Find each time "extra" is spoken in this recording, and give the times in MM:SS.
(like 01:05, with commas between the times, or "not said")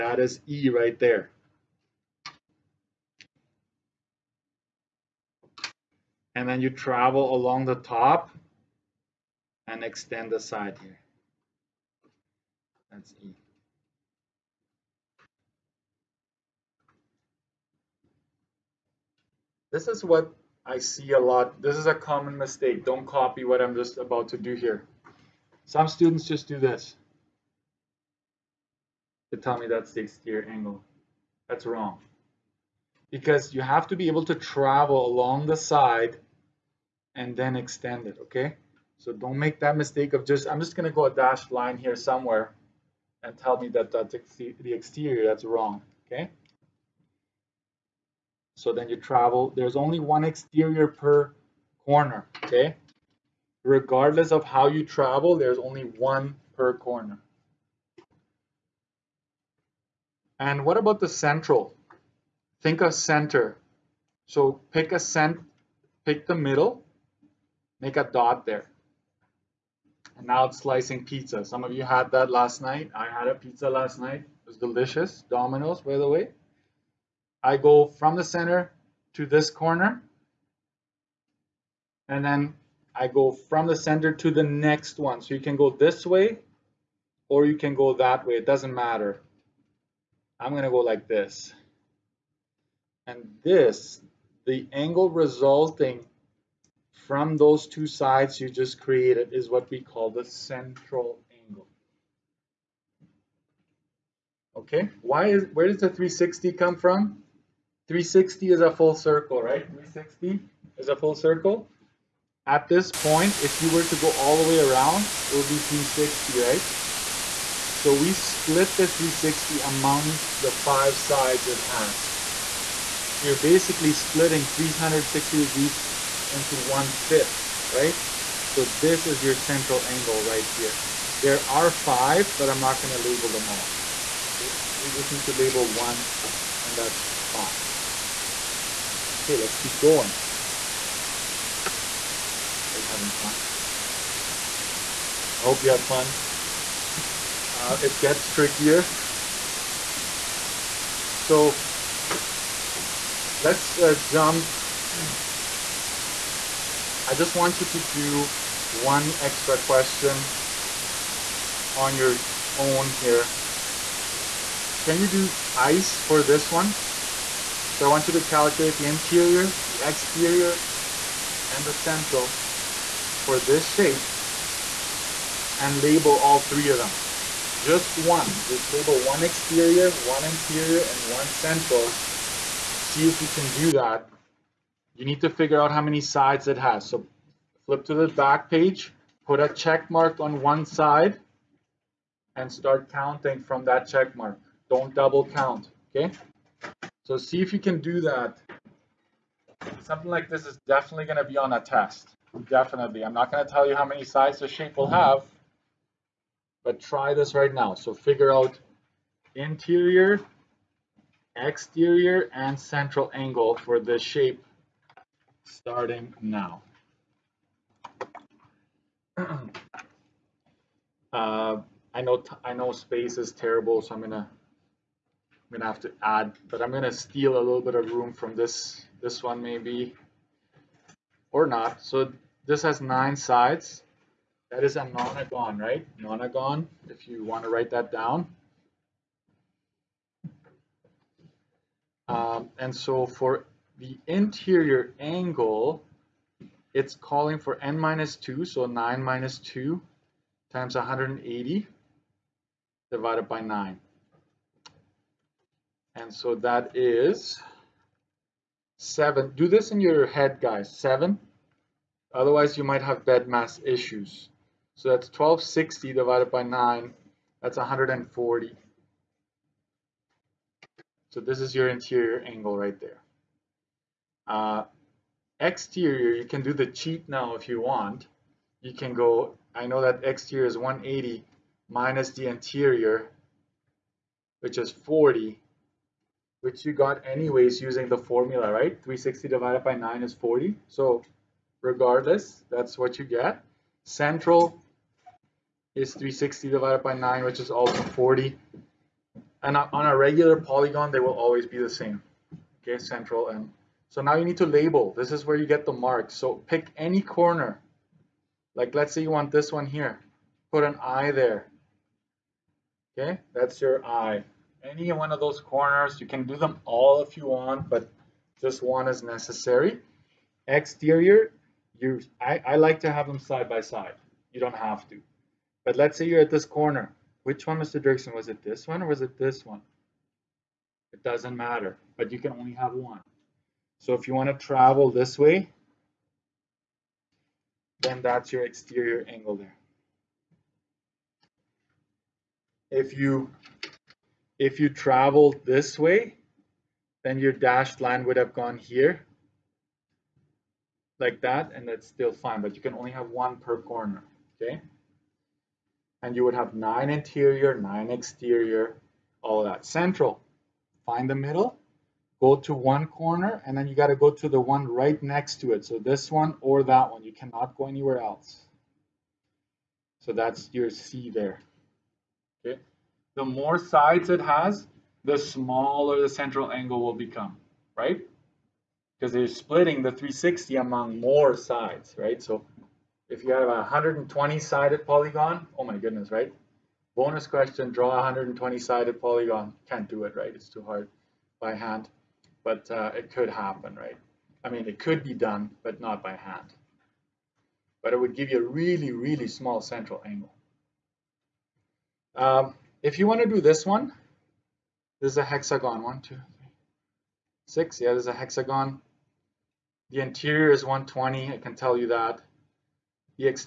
02:39.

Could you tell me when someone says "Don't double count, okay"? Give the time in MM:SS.
03:14.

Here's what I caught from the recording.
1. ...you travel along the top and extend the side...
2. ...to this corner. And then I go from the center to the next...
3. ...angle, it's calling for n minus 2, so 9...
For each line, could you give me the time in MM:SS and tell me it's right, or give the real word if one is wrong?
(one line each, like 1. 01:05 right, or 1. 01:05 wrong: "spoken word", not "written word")
1. 00:06 right
2. 01:19 right
3. 04:04 right.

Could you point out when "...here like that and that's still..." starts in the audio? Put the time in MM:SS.
05:48.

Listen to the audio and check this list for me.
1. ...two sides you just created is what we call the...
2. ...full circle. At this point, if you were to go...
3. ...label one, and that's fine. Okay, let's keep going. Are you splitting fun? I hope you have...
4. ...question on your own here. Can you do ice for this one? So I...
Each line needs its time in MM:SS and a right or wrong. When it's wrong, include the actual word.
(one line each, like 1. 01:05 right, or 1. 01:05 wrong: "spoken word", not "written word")
1. 01:37 right
2. 01:50 right
3. 02:15 wrong: "having", not "splitting"
4. 02:39 right.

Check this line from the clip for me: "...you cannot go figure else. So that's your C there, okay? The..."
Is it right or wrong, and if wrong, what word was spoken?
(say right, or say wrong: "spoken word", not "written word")
wrong: "anywhere", not "figure".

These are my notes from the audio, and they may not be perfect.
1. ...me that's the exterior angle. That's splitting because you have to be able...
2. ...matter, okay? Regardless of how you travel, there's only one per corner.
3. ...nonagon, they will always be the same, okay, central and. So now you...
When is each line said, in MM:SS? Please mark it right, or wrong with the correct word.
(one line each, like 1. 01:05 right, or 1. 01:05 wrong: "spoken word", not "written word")
1. 00:29 wrong: "wrong", not "splitting"
2. 00:51 wrong: "corner", not "matter"
3. 05:00 wrong: "polygon", not "nonagon".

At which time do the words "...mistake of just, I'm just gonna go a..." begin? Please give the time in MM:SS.
00:39.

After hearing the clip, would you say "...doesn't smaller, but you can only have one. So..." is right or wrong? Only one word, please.
wrong.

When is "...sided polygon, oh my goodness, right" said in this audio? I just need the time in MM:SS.
06:24.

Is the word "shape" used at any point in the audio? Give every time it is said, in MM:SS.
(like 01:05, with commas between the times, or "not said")
02:53, 03:24, 03:33.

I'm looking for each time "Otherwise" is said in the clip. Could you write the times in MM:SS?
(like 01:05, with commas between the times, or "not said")
04:22.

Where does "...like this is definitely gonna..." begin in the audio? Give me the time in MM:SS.
03:20.